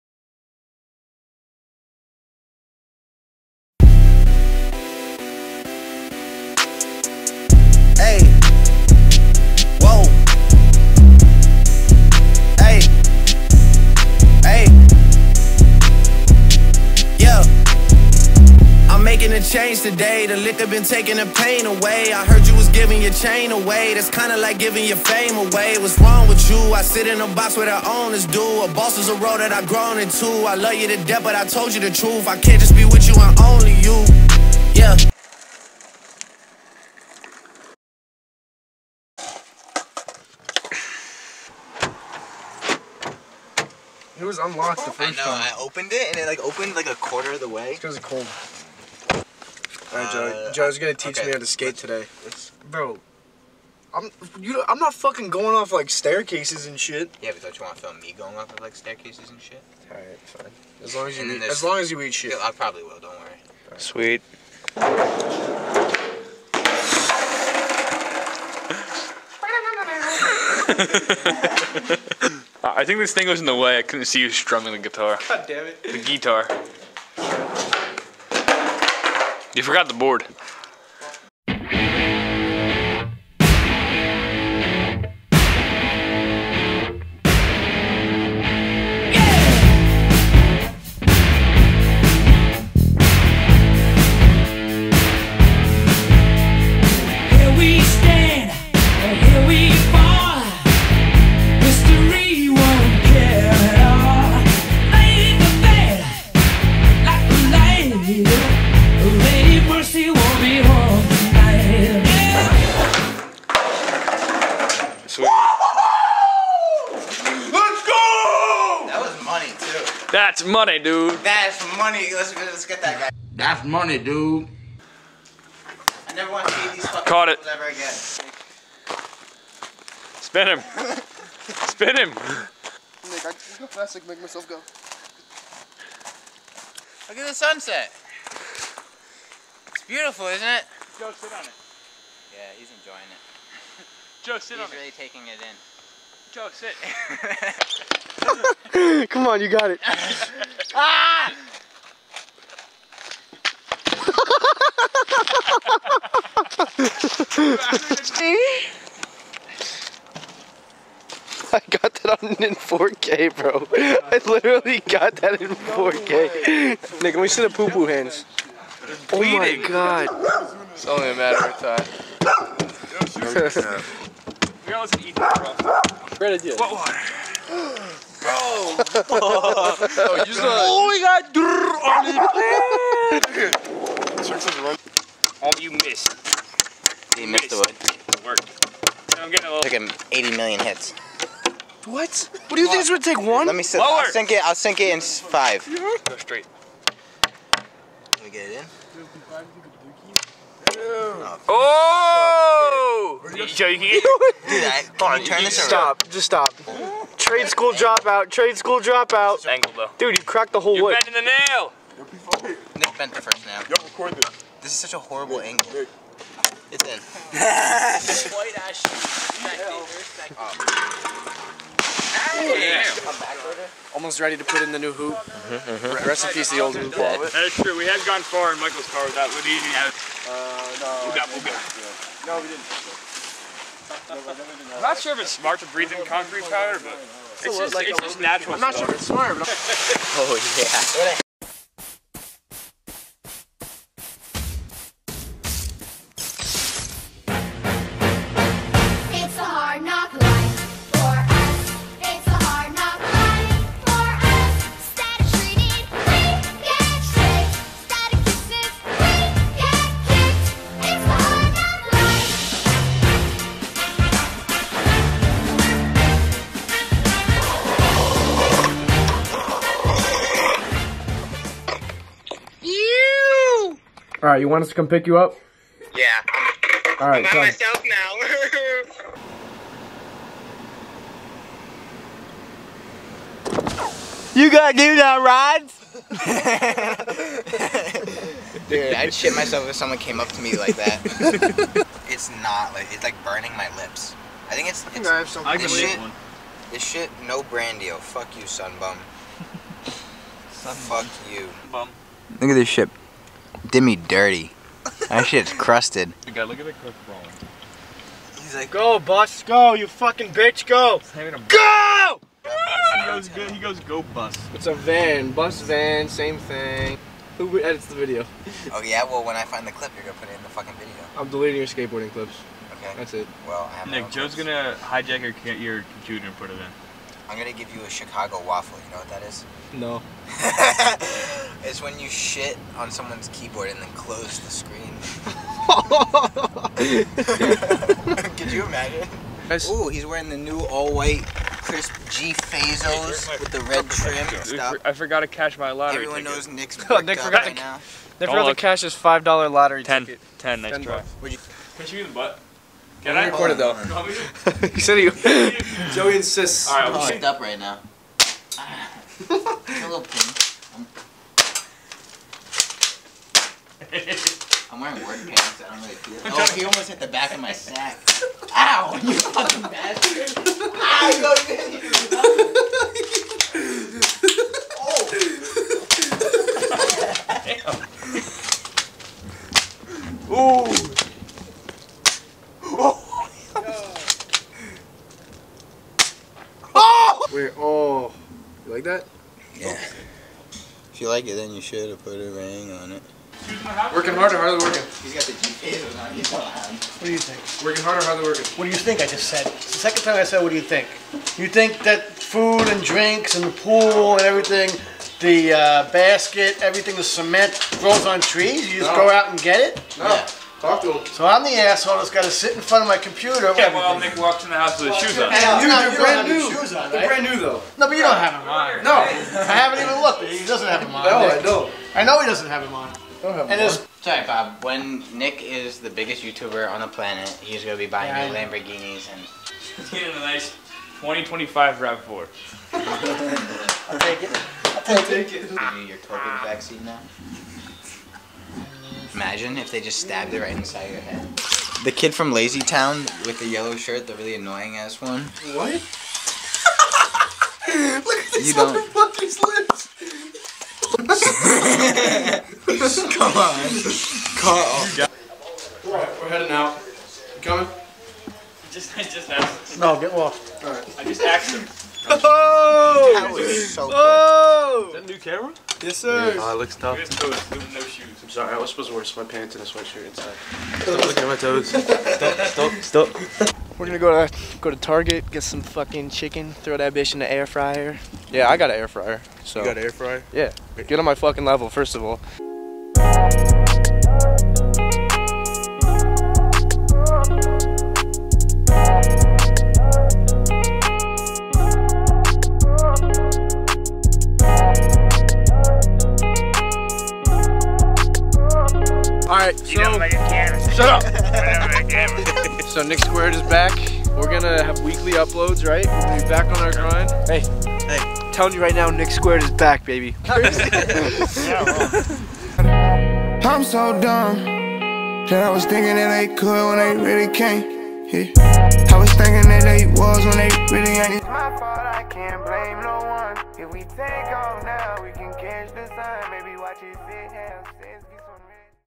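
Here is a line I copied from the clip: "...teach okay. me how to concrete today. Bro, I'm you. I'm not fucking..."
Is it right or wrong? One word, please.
wrong.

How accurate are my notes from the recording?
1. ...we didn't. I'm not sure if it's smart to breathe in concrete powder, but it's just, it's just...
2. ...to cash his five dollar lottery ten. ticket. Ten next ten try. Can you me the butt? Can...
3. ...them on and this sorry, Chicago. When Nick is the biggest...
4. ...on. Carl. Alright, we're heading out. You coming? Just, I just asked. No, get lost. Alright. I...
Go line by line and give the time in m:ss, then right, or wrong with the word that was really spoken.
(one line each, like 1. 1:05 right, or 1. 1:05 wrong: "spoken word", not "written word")
1. 3:52 right
2. 5:48 right
3. 7:02 wrong: "Bob", not "Chicago"
4. 7:33 right.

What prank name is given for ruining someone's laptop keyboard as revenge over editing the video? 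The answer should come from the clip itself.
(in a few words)
Chicago waffle.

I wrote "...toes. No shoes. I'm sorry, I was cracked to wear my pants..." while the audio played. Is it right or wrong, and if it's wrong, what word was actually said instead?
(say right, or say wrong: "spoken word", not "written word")
wrong: "supposed", not "cracked".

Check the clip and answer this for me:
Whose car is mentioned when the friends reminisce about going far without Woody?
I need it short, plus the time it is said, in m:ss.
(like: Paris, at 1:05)
Michael's, at 3:48.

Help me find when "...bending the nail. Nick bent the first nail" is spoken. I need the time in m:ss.
3:31.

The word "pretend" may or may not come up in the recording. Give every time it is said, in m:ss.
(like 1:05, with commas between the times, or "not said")
not said.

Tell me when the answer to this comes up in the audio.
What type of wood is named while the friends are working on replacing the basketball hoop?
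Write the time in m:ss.
3:37.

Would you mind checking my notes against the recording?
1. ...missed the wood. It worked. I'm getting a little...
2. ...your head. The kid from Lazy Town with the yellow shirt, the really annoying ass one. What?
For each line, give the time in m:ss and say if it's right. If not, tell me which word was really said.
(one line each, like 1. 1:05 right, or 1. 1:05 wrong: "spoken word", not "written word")
1. 3:07 right
2. 7:20 right.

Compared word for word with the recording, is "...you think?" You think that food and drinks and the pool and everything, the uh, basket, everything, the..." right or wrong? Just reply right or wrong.
right.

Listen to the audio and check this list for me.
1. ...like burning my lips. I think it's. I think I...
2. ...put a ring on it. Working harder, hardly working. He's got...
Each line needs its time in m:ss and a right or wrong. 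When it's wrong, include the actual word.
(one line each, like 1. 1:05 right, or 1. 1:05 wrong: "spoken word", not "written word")
1. 4:53 right
2. 6:32 right.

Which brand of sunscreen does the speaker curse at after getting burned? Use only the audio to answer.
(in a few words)
Sun Bum.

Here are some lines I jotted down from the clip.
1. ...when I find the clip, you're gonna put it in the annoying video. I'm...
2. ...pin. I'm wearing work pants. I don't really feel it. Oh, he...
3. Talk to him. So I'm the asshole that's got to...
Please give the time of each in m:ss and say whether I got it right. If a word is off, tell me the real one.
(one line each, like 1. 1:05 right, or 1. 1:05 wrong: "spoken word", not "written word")
1. 5:19 wrong: "fucking", not "annoying"
2. 6:00 right
3. 6:50 right.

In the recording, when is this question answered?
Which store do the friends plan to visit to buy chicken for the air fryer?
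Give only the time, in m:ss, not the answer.
7:54.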